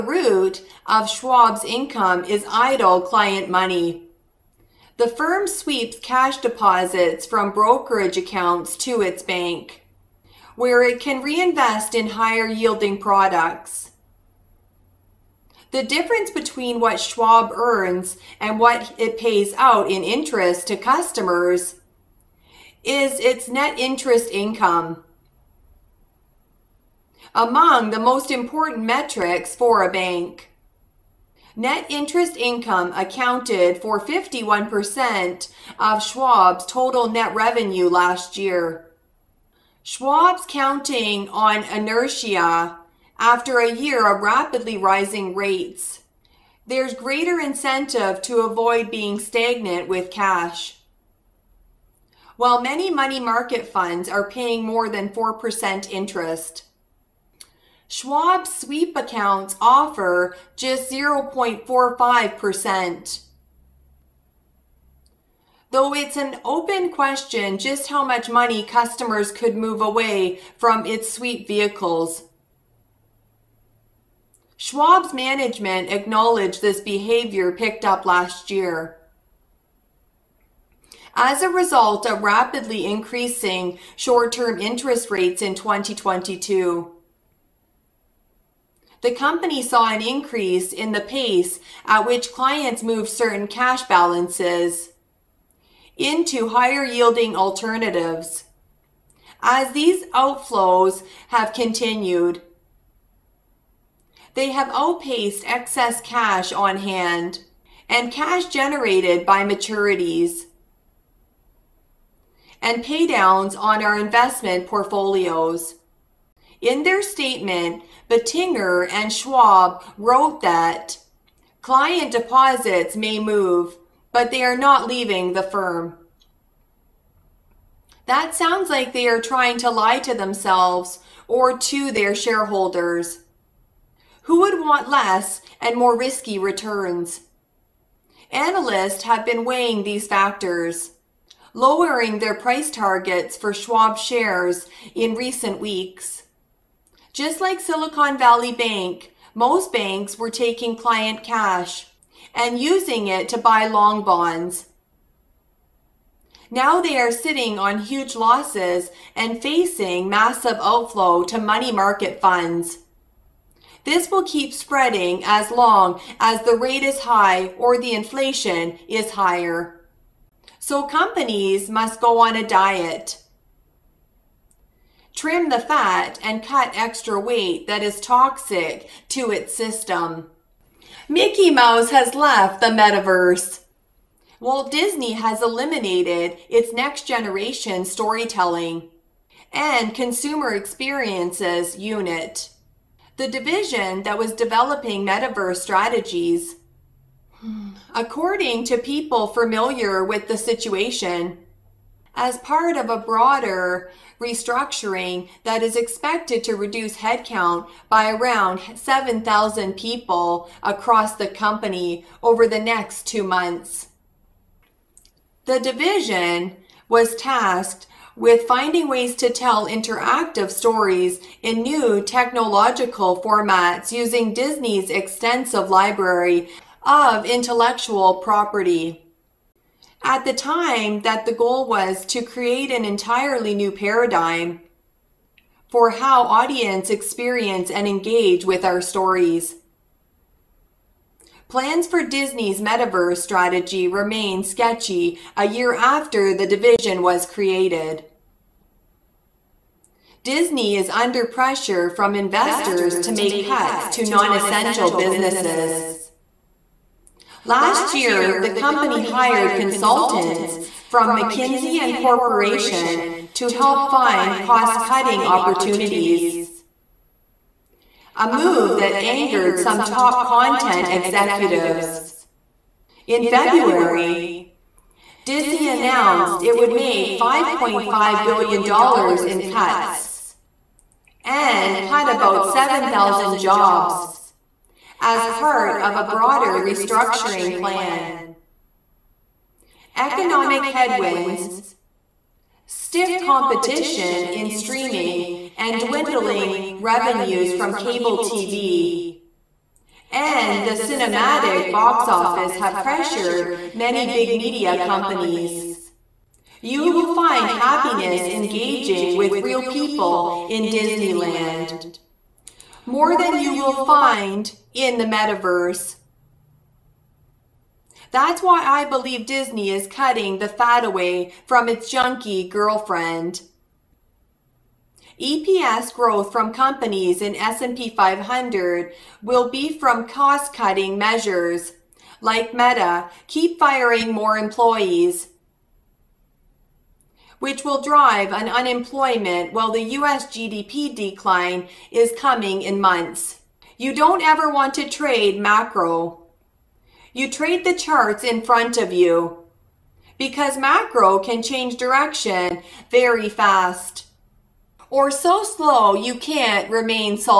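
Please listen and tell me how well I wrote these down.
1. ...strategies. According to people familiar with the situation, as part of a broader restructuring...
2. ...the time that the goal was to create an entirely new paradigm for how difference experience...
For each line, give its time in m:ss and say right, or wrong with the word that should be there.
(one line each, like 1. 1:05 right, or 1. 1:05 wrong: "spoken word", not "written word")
1. 3:15 right
2. 3:50 wrong: "audience", not "difference".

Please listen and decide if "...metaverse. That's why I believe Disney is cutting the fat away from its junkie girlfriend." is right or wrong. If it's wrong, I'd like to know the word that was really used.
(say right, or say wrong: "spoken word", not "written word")
right.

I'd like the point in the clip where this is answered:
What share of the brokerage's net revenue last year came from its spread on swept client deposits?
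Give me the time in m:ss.
0:33.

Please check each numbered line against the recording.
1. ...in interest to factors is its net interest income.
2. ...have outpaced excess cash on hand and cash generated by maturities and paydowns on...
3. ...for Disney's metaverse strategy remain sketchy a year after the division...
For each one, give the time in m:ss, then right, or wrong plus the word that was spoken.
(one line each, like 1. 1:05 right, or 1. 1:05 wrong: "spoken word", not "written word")
1. 0:19 wrong: "customers", not "factors"
2. 1:44 right
3. 4:01 right.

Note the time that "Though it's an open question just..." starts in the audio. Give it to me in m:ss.
1:05.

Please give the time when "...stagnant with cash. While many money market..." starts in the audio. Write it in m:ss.
0:49.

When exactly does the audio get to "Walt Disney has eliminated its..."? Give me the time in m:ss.
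3:04.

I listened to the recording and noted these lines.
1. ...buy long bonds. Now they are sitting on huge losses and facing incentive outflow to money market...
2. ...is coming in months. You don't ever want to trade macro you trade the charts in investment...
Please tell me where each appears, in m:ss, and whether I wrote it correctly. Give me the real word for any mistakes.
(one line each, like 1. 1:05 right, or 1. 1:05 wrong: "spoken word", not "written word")
1. 2:33 wrong: "massive", not "incentive"
2. 5:41 wrong: "front", not "investment".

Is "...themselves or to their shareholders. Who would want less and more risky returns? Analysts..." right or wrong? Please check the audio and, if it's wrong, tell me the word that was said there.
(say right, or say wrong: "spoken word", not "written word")
right.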